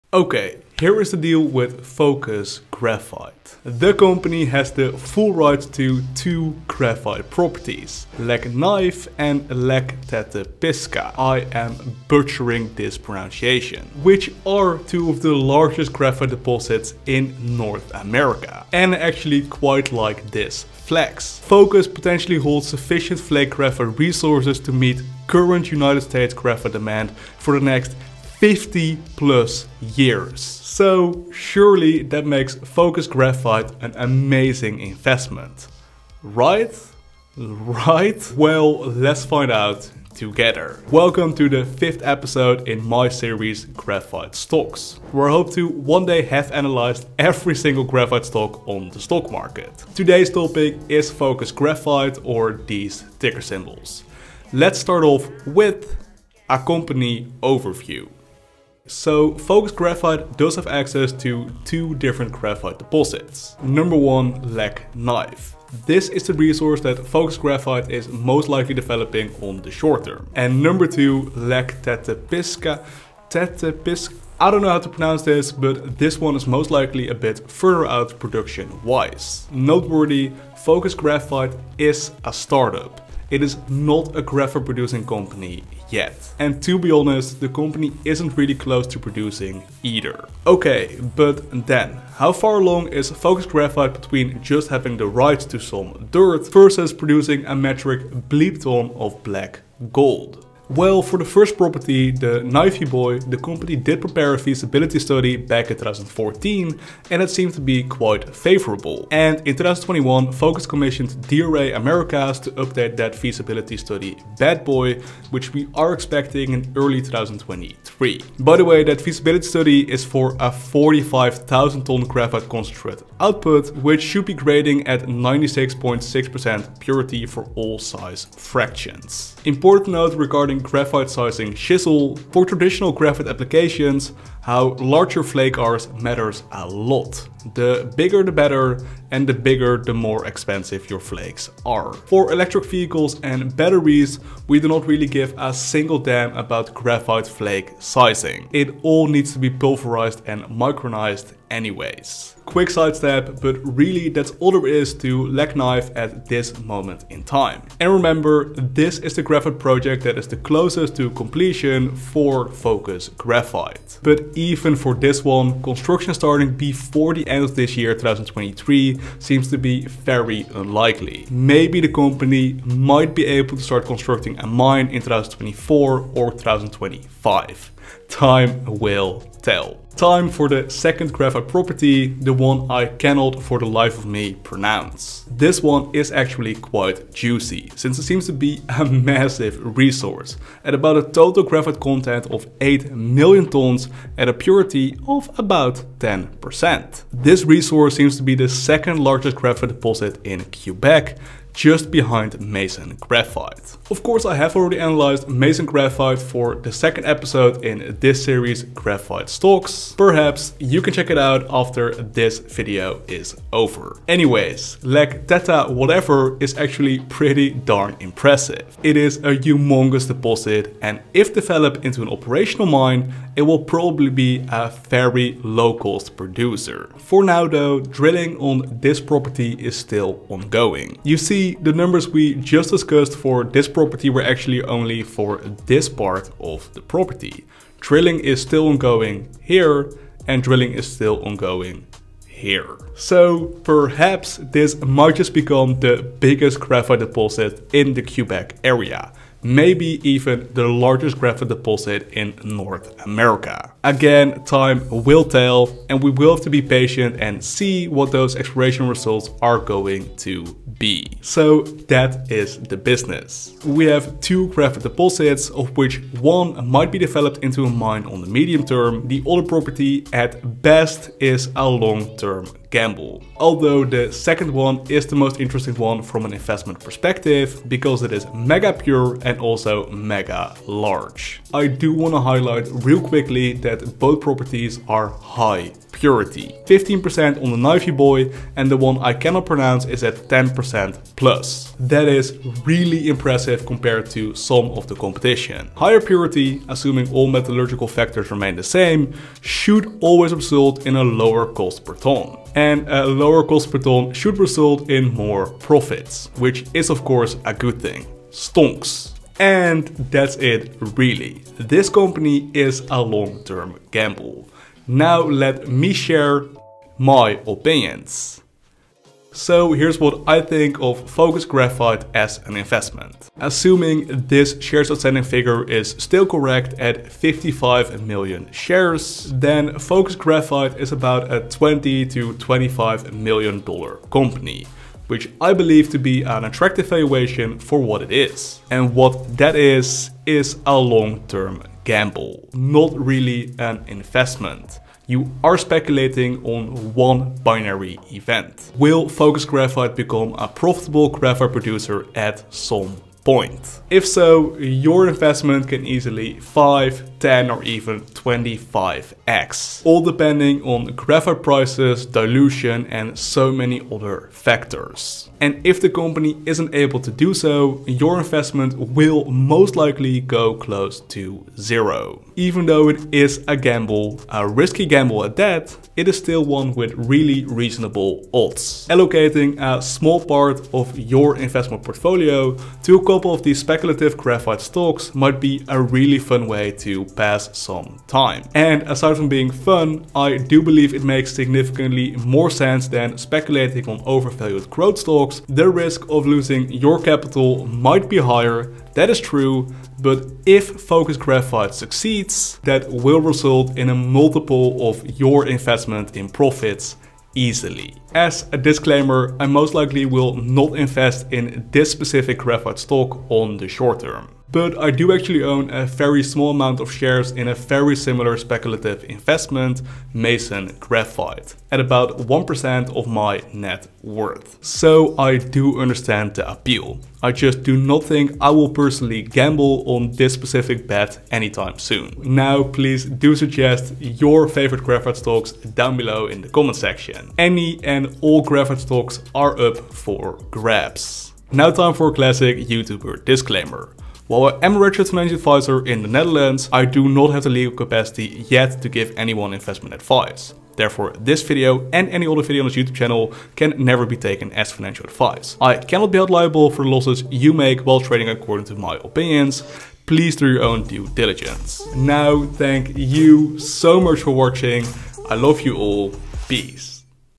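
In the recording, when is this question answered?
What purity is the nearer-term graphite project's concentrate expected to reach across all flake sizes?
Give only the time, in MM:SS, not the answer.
02:05.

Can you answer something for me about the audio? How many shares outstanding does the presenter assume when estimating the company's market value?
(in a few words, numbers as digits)
55 million.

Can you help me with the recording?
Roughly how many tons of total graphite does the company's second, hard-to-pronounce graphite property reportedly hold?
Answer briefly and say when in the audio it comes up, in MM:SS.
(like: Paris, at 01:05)
8 million, at 03:12.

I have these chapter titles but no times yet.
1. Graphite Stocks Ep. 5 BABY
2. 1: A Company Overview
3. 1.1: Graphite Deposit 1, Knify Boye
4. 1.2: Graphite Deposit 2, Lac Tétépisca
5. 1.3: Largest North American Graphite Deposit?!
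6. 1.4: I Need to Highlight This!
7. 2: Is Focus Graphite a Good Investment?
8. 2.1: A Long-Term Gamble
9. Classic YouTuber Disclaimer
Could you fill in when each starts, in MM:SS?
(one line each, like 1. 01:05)
1. 00:38
2. 00:56
3. 01:40
4. 02:32
5. 03:47
6. 04:41
7. 05:15
8. 06:12
9. 07:21.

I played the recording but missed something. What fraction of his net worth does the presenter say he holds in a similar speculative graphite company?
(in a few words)
1%.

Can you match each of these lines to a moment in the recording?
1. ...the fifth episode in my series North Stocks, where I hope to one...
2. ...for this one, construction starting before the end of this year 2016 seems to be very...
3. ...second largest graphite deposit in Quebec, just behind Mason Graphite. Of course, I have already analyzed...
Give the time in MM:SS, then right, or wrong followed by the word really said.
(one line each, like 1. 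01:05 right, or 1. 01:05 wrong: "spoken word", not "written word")
1. 00:41 wrong: "Graphite", not "North"
2. 02:44 wrong: "2023", not "2016"
3. 03:18 right.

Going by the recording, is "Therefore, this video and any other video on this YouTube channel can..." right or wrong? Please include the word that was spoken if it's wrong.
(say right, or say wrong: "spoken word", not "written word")
right.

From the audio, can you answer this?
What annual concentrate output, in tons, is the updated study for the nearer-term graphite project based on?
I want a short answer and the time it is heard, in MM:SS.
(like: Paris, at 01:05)
45,000, at 02:00.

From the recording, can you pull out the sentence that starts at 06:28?
And aside from being fun, I do believe it makes significantly more sense than speculating on overvalued growth stocks.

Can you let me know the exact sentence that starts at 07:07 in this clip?
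I just do not think I will personally gamble on this specific bet anytime soon.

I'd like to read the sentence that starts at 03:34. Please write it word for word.
Anyways, Lac Teta whatever is actually pretty darn impressive.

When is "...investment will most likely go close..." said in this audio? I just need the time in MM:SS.
06:08.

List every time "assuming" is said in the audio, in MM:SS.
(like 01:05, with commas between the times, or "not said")
04:56, 05:23.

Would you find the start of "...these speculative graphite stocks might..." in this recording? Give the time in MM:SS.
06:23.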